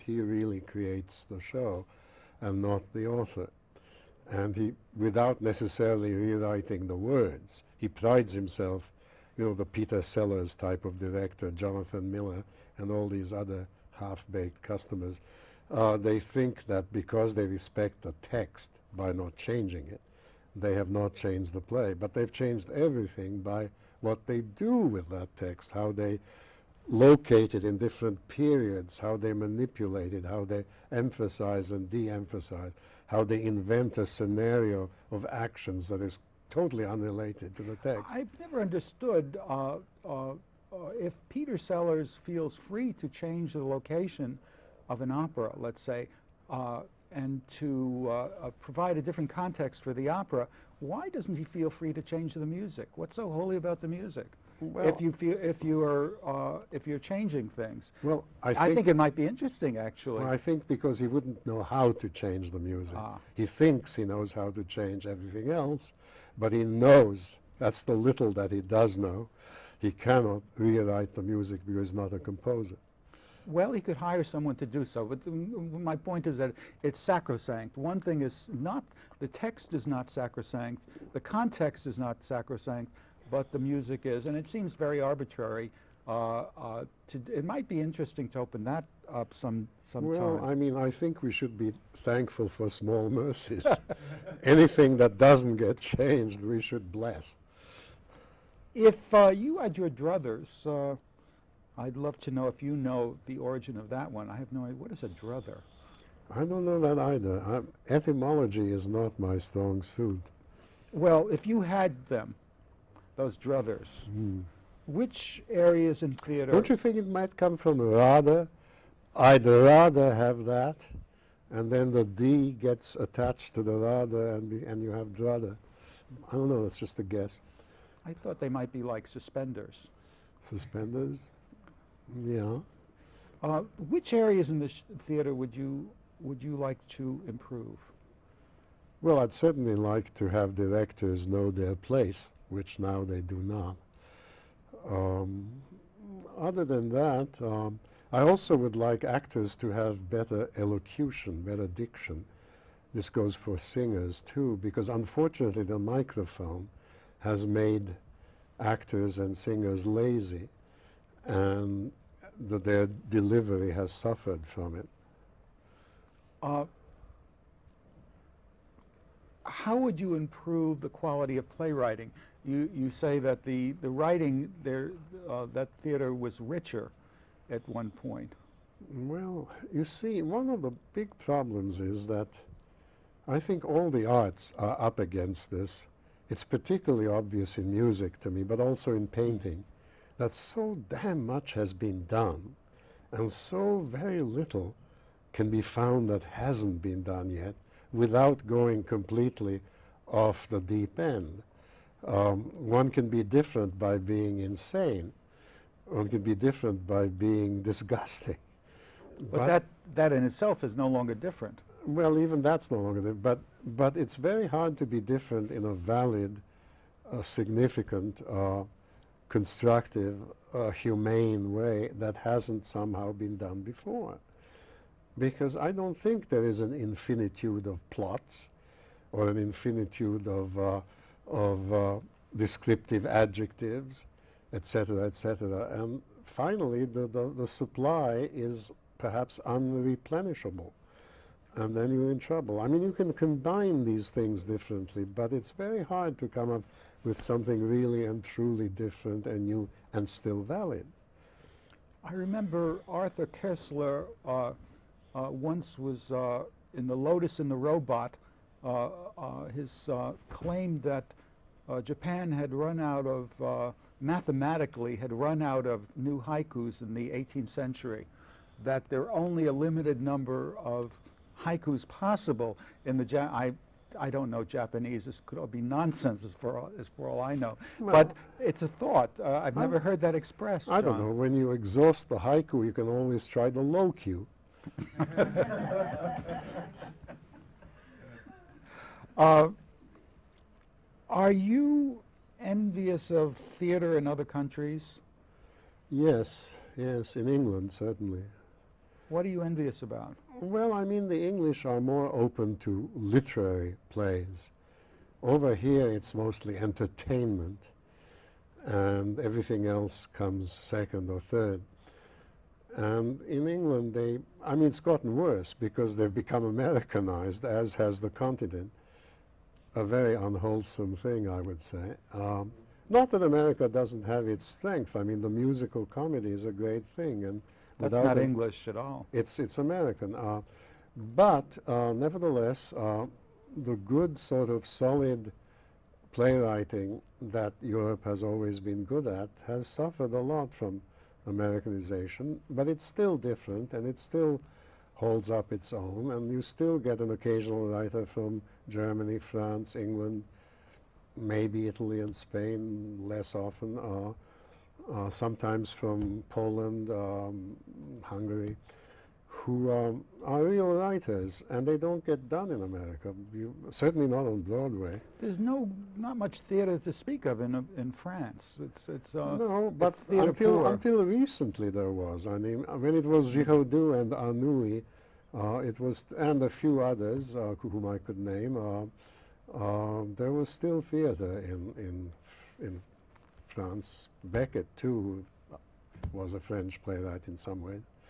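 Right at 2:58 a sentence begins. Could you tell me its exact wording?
Well, you see, one of the big problems is that I think all the arts are up against this.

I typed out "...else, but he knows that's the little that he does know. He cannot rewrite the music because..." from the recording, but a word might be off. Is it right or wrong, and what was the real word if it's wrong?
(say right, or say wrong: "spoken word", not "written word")
right.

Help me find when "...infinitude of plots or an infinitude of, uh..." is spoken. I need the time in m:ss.
3:46.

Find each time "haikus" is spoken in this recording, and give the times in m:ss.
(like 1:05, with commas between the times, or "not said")
4:26, 4:31, 4:42.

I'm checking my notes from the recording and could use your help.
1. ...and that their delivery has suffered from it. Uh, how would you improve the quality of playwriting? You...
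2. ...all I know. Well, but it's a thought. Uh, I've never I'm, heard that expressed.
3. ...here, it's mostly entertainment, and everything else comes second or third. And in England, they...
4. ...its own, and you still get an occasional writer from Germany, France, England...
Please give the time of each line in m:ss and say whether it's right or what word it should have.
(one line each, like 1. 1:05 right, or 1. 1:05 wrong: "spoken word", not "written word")
1. 2:41 right
2. 4:37 right
3. 5:05 right
4. 5:45 right.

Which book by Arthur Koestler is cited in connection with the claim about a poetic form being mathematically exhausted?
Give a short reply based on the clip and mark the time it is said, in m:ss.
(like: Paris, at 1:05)
The Lotus and the Robot, at 4:16.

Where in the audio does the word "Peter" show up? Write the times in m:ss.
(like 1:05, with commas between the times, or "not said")
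0:09, 0:41.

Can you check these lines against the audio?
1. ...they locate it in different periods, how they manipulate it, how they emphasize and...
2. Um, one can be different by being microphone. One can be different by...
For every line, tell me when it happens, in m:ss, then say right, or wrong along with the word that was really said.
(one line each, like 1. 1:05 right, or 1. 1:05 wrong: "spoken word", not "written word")
1. 0:25 right
2. 3:22 wrong: "insane", not "microphone".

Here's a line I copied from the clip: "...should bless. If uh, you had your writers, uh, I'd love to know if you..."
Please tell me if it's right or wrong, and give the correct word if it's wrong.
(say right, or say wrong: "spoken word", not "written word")
wrong: "druthers", not "writers".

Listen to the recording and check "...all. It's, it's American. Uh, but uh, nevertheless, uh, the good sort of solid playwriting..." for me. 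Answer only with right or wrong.
right.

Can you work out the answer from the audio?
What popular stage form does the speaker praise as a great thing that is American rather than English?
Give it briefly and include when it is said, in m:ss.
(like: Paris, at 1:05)
musical comedy, at 5:25.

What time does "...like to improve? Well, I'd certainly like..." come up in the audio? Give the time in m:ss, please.
2:16.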